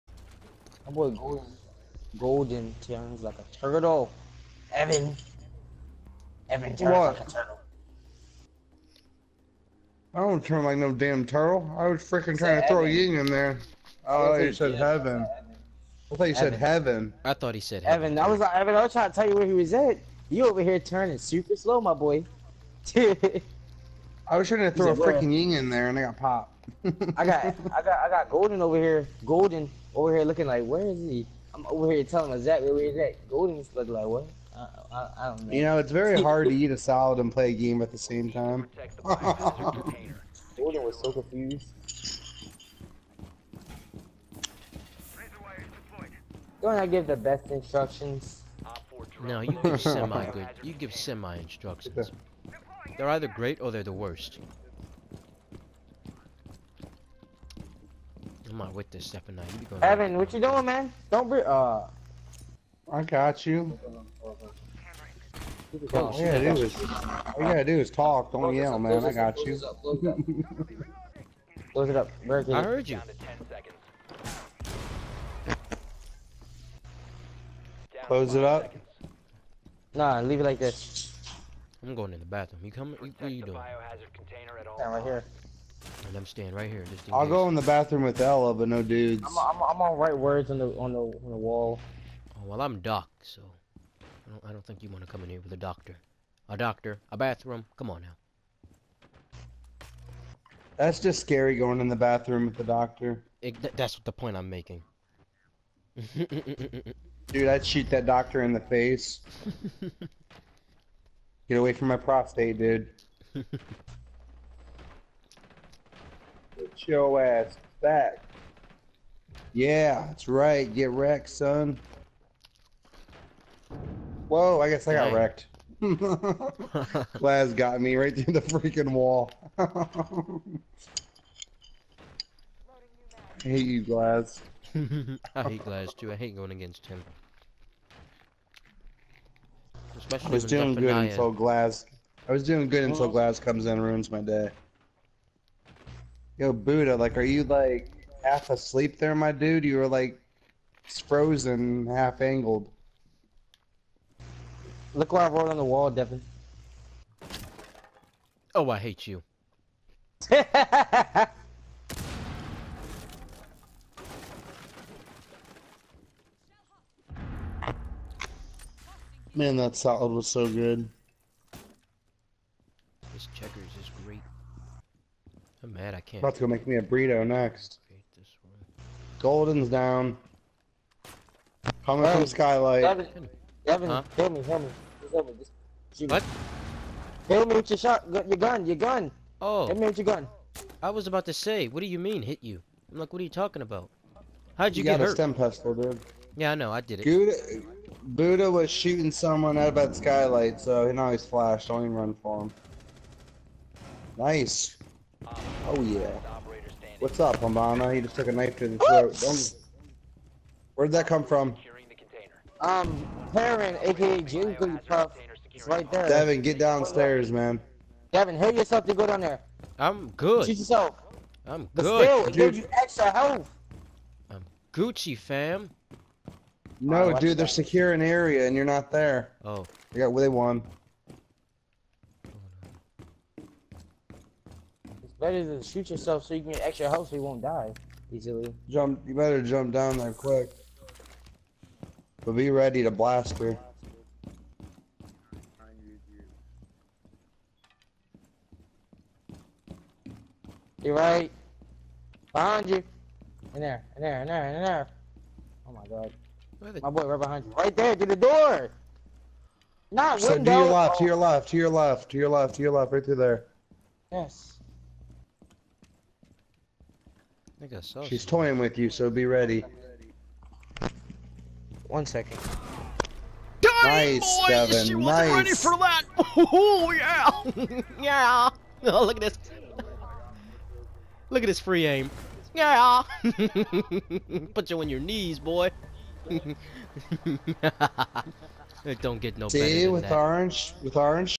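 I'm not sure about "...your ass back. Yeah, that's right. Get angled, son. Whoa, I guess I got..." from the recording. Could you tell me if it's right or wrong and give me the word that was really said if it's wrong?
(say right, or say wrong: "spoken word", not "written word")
wrong: "wrecked", not "angled".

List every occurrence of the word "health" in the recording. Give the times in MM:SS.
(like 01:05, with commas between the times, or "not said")
03:43, 03:56.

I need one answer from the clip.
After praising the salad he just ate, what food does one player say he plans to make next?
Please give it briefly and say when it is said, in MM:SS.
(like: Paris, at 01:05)
burrito, at 02:56.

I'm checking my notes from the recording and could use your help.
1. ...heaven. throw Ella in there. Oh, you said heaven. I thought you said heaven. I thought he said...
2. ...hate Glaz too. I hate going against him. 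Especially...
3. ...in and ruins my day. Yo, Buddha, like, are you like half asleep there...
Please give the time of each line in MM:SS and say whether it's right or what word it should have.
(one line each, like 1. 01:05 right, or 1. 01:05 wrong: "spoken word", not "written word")
1. 00:12 wrong: "Ying", not "Ella"
2. 02:15 right
3. 02:23 right.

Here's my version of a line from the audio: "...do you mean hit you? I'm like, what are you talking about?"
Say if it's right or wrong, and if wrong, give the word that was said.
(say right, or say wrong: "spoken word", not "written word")
right.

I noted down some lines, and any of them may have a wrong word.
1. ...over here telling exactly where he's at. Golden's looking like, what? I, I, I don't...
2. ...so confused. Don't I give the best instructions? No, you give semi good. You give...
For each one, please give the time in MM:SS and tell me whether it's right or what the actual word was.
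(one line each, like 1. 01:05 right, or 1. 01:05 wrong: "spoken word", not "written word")
1. 00:31 right
2. 00:41 right.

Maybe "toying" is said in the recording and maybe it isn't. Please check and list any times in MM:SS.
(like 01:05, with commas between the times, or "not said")
04:28.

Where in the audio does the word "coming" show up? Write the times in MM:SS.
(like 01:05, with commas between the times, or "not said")
01:22, 03:01.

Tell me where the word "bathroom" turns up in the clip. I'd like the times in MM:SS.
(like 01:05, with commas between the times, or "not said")
01:22, 01:27, 01:37, 01:41.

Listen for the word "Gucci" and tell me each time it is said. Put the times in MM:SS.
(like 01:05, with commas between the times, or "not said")
03:44.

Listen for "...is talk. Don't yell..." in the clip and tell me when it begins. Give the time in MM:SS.
01:07.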